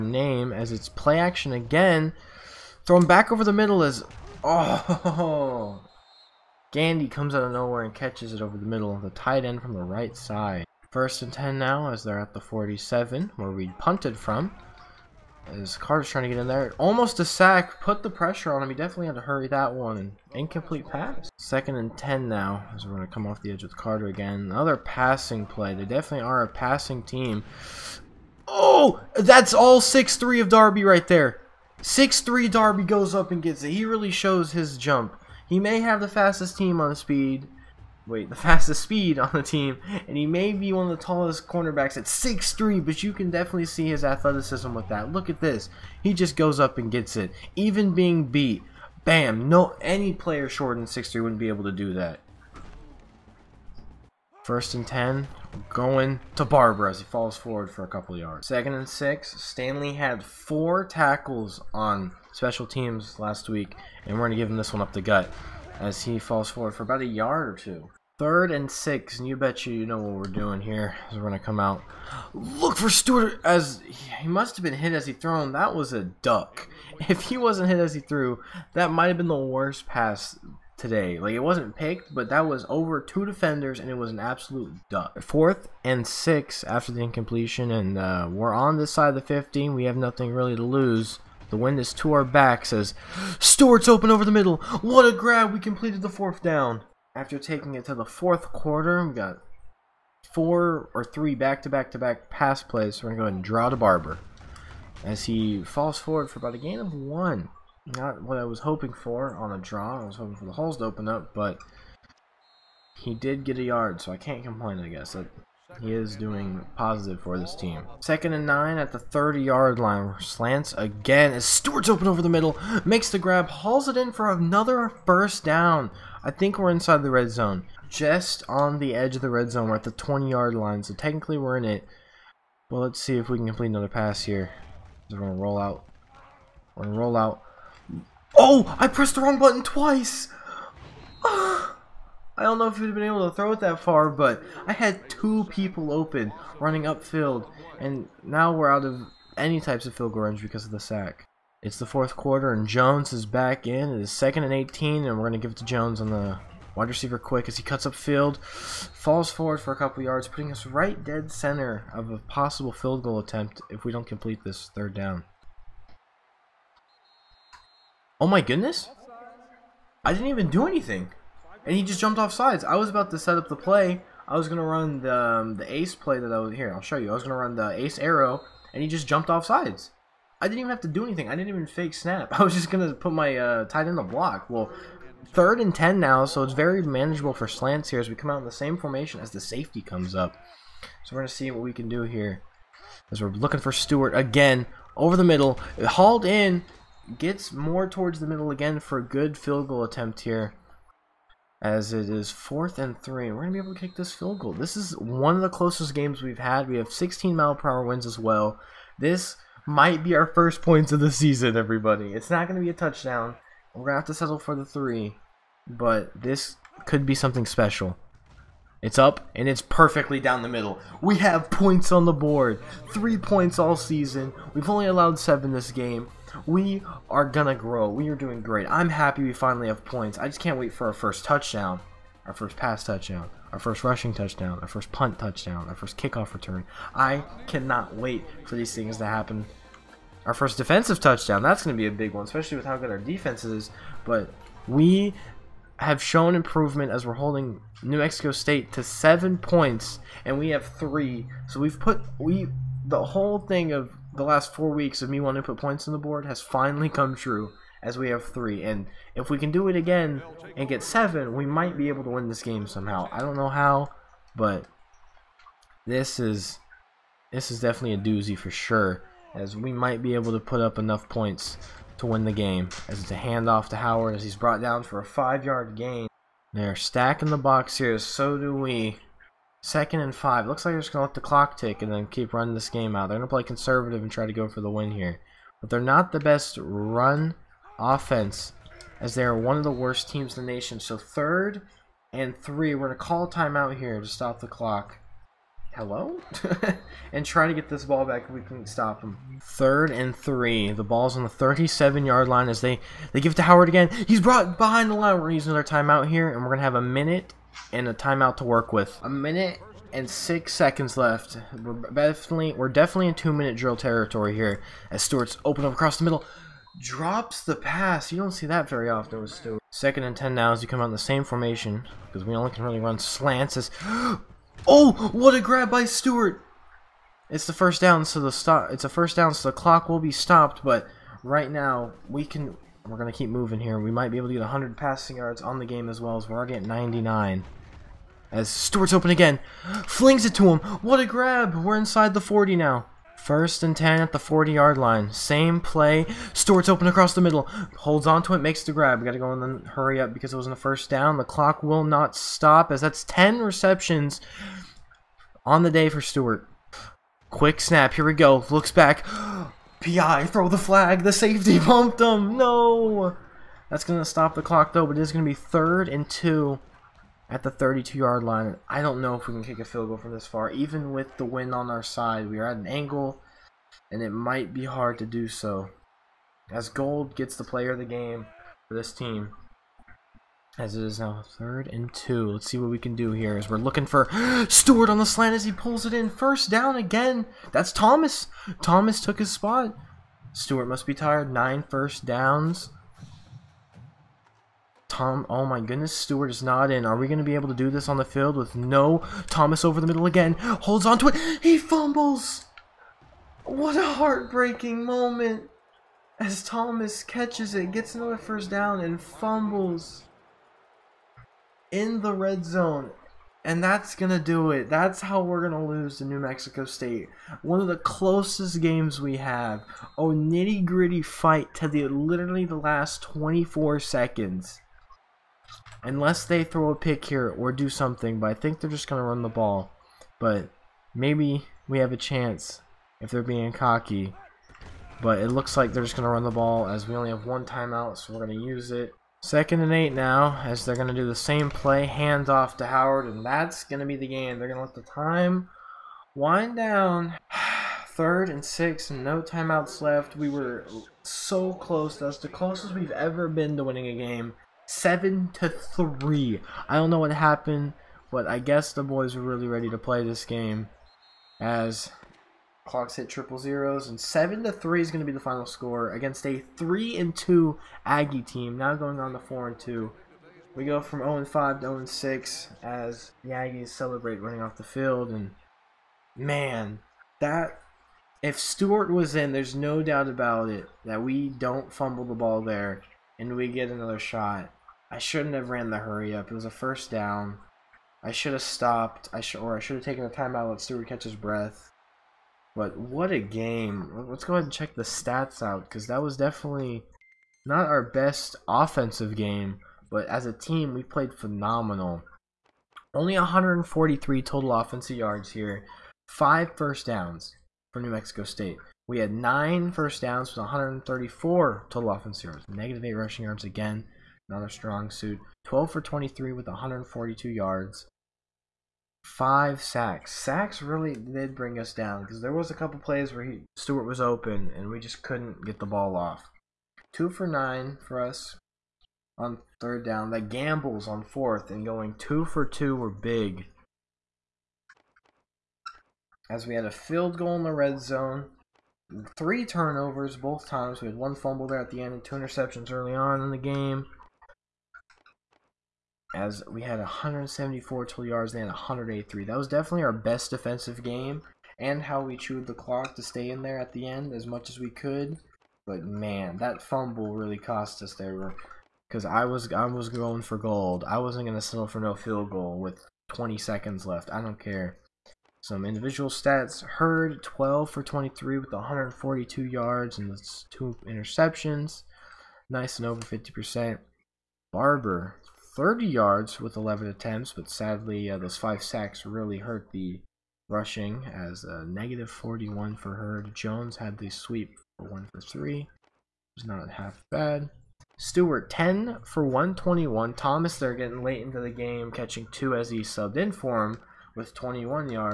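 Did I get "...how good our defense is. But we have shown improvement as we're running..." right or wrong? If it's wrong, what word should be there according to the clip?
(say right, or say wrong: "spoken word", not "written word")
wrong: "holding", not "running".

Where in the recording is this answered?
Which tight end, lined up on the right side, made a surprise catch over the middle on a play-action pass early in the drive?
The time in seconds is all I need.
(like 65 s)
6 s.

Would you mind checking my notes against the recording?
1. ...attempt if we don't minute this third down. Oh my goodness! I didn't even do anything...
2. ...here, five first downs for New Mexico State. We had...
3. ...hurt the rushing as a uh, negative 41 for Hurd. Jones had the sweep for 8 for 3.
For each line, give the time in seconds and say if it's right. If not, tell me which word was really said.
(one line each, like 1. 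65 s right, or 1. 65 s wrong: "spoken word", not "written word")
1. 163 s wrong: "complete", not "minute"
2. 505 s right
3. 579 s wrong: "1", not "8".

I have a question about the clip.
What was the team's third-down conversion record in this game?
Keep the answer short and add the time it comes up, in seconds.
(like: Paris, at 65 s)
2 for 9, at 526 s.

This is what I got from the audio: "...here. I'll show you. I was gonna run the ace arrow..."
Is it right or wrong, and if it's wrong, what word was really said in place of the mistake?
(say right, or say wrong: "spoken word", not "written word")
right.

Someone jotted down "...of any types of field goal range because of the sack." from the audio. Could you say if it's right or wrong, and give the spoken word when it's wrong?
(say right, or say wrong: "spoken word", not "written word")
right.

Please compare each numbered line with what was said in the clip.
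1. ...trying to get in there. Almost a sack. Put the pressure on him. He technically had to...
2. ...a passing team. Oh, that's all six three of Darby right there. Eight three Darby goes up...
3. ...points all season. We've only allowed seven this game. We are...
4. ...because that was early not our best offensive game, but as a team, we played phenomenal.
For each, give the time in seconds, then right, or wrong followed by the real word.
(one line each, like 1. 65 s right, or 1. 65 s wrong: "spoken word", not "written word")
1. 16 s wrong: "definitely", not "technically"
2. 26 s wrong: "Six", not "Eight"
3. 223 s right
4. 495 s wrong: "definitely", not "early".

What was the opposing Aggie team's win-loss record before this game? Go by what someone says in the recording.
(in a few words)
3-2.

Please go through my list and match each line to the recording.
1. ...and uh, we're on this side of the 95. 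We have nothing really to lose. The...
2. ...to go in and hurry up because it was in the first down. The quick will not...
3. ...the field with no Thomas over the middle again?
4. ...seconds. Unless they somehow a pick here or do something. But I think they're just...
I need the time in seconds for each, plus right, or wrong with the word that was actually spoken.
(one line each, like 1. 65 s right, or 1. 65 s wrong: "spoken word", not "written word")
1. 87 s wrong: "15", not "95"
2. 349 s wrong: "clock", not "quick"
3. 397 s right
4. 423 s wrong: "throw", not "somehow".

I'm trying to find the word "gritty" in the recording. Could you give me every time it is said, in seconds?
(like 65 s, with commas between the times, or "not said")
420 s.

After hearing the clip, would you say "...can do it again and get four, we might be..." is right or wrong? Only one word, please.
wrong.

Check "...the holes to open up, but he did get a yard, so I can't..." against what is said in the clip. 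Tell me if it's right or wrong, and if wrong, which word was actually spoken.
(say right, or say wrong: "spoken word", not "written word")
right.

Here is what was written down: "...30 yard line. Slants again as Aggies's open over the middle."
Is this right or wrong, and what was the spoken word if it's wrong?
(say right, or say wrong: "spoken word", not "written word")
wrong: "Stewart", not "Aggies".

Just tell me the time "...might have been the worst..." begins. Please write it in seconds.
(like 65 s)
78 s.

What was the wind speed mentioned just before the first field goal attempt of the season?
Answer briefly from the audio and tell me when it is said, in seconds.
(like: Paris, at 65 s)
16 mph, at 206 s.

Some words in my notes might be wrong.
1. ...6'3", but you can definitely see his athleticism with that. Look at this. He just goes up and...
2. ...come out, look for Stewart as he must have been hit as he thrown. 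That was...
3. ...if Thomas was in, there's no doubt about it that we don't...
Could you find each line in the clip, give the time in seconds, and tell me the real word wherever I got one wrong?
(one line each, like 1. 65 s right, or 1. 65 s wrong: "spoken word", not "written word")
1. 42 s right
2. 71 s right
3. 478 s wrong: "Stewart", not "Thomas".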